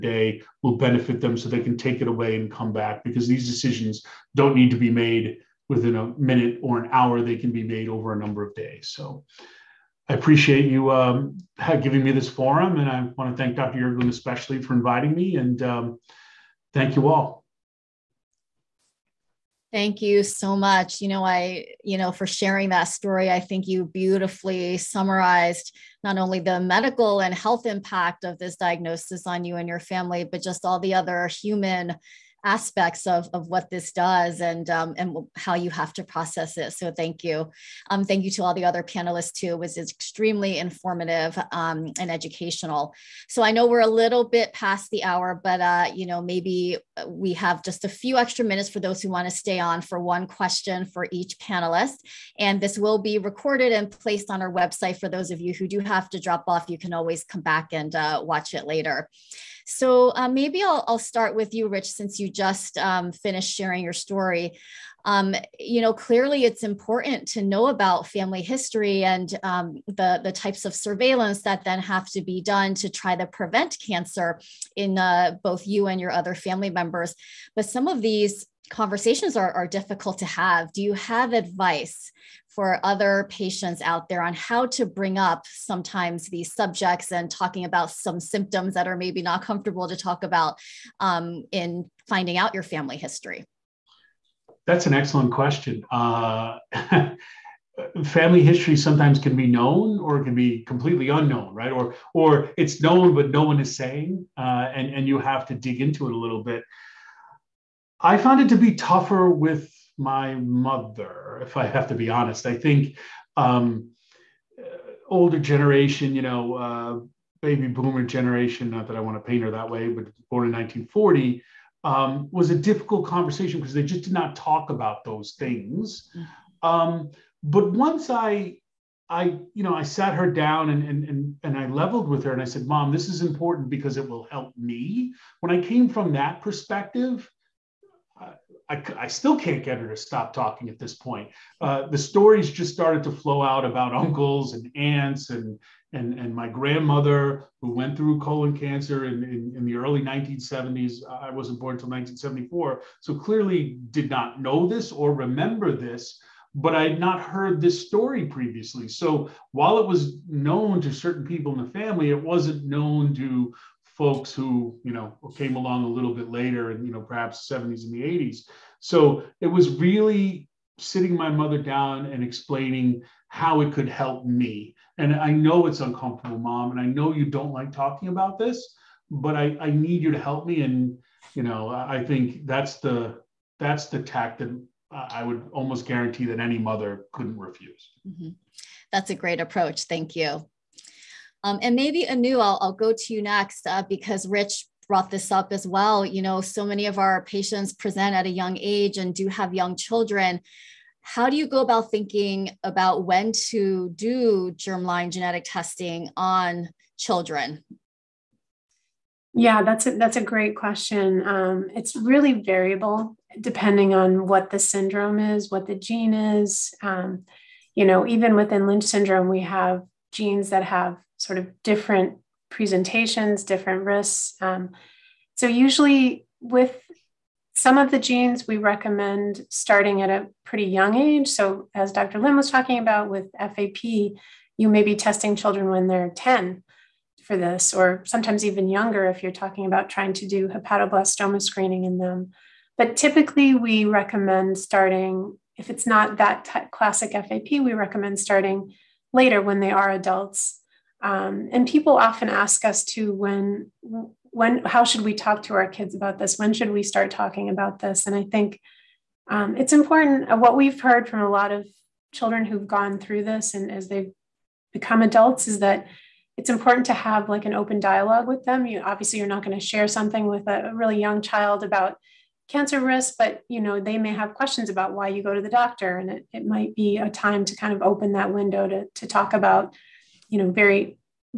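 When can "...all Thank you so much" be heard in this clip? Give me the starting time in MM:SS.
00:17.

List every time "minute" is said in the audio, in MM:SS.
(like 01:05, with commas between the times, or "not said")
00:06, 00:48.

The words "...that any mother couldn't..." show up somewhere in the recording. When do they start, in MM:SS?
03:06.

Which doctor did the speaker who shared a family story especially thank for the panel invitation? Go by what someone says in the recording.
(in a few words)
Dr. Yurgelun.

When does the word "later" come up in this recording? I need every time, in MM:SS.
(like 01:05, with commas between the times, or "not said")
00:58, 02:46, 04:09.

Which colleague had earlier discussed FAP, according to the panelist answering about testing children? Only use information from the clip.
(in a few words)
Dr. Lim.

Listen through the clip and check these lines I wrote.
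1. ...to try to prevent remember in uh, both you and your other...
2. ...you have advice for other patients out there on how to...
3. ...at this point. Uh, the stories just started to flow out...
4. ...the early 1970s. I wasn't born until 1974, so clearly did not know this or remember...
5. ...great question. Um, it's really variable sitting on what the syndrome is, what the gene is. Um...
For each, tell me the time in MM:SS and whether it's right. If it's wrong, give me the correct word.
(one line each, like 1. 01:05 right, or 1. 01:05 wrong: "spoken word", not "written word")
1. 01:12 wrong: "cancer", not "remember"
2. 01:20 right
3. 02:20 right
4. 02:29 right
5. 03:30 wrong: "depending", not "sitting".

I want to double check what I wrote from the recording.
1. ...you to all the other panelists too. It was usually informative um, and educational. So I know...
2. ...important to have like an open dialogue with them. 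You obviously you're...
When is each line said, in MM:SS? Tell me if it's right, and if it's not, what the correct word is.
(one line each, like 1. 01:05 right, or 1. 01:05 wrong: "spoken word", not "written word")
1. 00:38 wrong: "extremely", not "usually"
2. 04:26 right.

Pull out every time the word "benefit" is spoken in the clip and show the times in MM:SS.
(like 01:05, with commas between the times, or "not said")
00:00.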